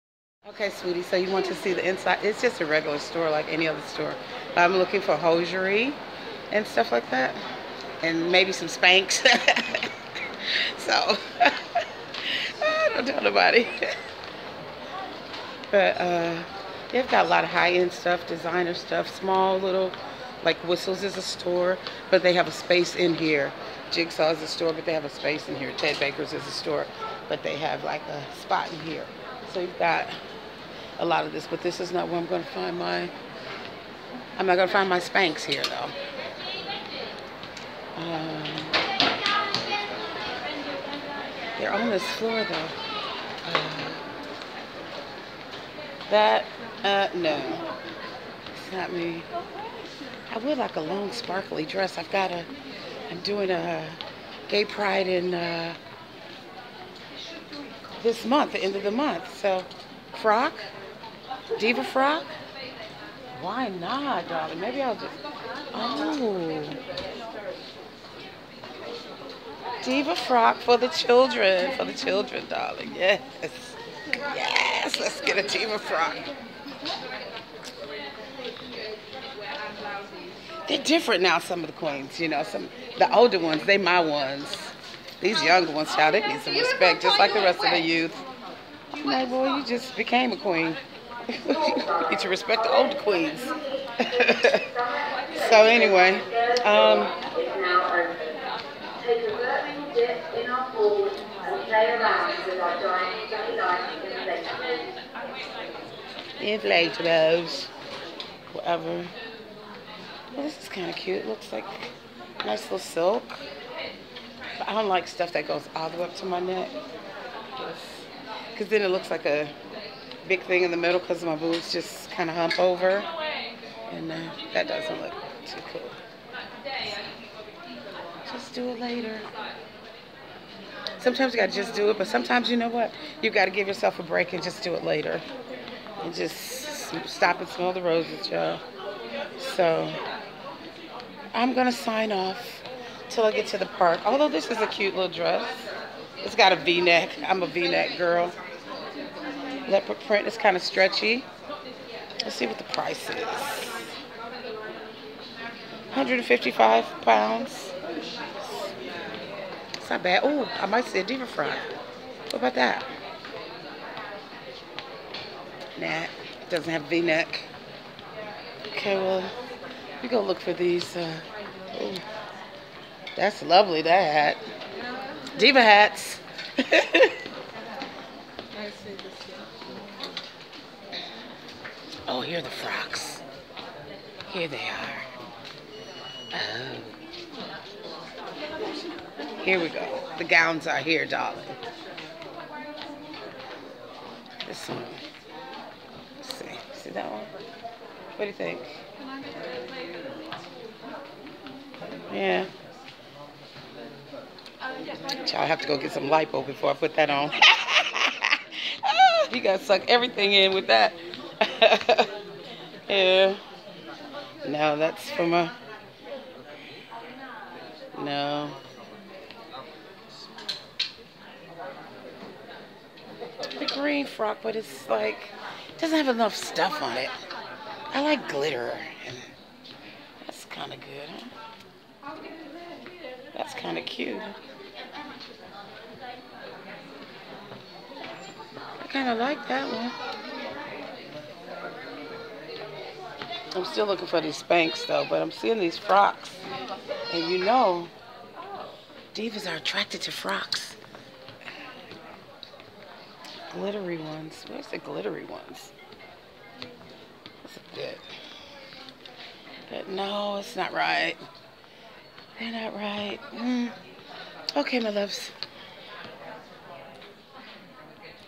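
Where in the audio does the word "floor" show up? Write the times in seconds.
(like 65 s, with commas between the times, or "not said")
42 s.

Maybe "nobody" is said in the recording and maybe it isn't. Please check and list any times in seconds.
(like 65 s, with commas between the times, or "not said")
13 s.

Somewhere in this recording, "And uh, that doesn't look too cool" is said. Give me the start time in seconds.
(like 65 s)
123 s.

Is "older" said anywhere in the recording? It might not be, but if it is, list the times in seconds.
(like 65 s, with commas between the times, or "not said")
83 s.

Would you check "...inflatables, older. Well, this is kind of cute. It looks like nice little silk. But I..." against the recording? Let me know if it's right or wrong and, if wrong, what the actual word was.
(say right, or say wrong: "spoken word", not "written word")
wrong: "whatever", not "older".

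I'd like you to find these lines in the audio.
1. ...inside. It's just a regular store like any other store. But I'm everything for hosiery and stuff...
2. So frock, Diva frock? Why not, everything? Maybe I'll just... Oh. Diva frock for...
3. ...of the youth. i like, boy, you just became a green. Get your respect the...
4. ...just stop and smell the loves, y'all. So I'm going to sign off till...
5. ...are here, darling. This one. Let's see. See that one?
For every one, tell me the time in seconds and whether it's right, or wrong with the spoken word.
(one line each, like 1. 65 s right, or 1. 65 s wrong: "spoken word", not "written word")
1. 1 s wrong: "looking", not "everything"
2. 59 s wrong: "darling", not "everything"
3. 87 s wrong: "queen", not "green"
4. 136 s wrong: "roses", not "loves"
5. 190 s right.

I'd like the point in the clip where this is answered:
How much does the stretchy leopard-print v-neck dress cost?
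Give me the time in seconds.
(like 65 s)
155 s.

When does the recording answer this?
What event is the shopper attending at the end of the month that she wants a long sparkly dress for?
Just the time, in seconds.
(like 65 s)
54 s.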